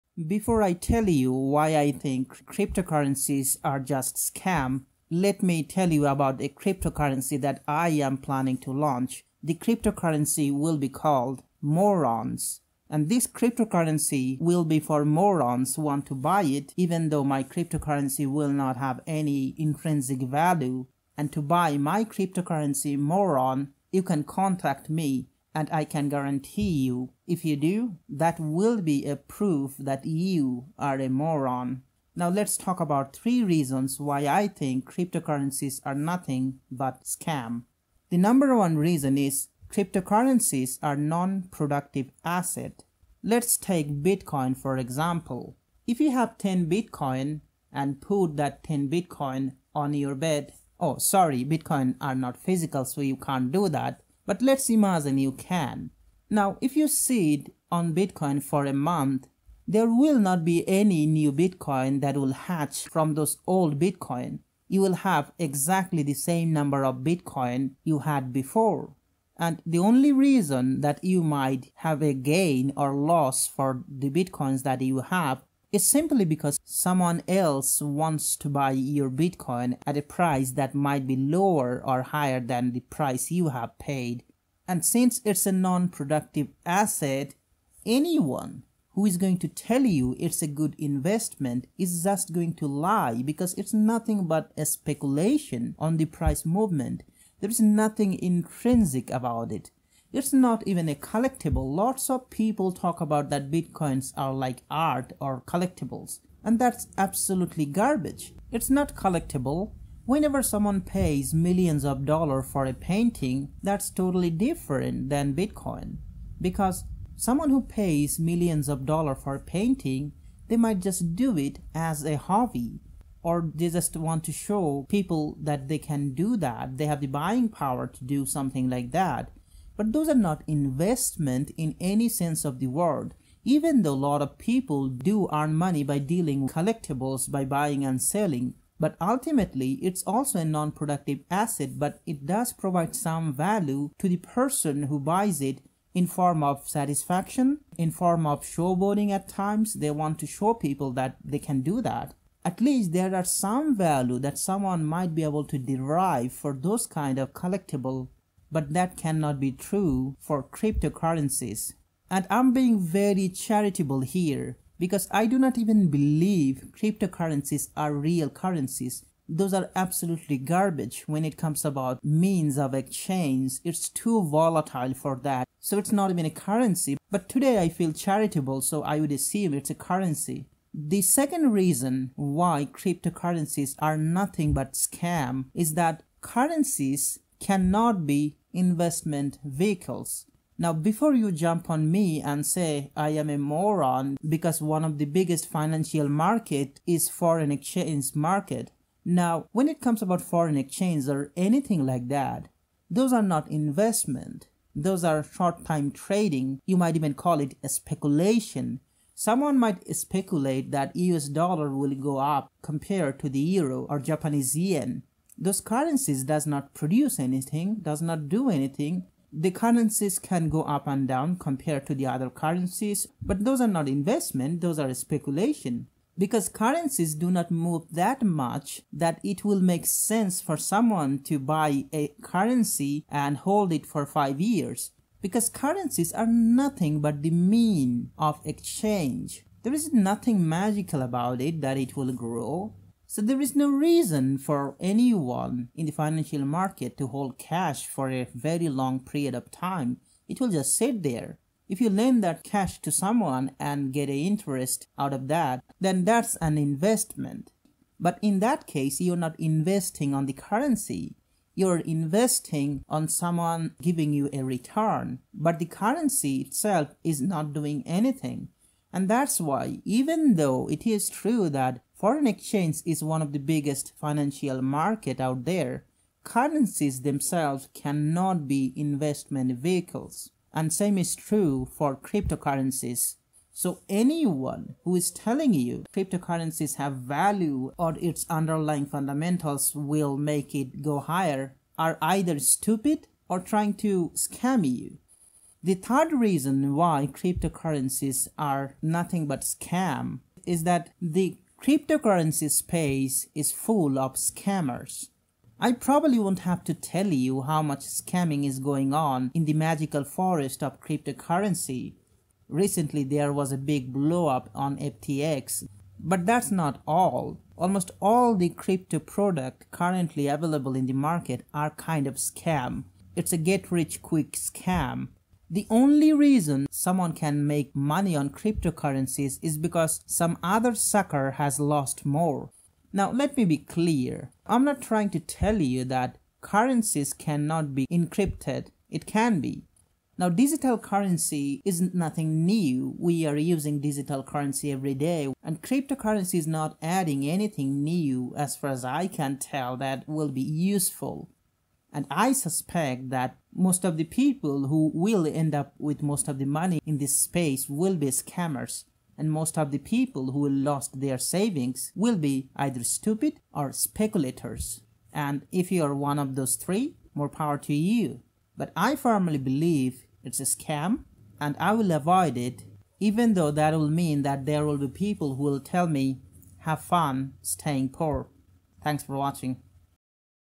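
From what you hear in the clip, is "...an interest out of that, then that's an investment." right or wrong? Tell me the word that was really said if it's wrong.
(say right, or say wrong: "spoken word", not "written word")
right.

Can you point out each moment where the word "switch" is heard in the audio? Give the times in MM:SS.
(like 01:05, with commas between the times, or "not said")
not said.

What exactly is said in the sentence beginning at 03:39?
The currencies can go up and down compared to the other currencies, but those are not investment, those are speculation.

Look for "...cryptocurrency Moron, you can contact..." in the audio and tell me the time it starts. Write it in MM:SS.
00:22.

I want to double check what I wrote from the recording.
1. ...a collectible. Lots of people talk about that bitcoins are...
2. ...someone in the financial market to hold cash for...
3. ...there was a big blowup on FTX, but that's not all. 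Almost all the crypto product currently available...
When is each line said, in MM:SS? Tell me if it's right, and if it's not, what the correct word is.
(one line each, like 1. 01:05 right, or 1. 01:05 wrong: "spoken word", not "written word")
1. 01:40 right
2. 04:04 wrong: "anyone", not "someone"
3. 05:13 right.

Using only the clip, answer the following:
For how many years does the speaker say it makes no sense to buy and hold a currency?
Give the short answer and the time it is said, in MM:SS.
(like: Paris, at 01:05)
5, at 03:54.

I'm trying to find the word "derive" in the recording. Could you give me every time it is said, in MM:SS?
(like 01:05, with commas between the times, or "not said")
02:35.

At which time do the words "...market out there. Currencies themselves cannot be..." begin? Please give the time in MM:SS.
04:34.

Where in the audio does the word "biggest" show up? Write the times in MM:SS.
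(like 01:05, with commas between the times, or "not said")
03:15, 04:33.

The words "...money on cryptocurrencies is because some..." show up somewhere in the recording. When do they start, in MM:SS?
05:27.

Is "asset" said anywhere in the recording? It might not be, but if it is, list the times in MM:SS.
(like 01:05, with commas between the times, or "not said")
00:42, 01:26, 02:21.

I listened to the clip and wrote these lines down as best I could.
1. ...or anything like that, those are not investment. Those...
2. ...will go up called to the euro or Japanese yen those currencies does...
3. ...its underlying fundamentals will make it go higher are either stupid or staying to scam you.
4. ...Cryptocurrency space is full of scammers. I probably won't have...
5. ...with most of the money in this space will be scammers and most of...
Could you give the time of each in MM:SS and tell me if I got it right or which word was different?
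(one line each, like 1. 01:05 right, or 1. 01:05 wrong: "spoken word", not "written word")
1. 03:21 right
2. 03:31 wrong: "compared", not "called"
3. 04:48 wrong: "trying", not "staying"
4. 05:01 right
5. 05:55 right.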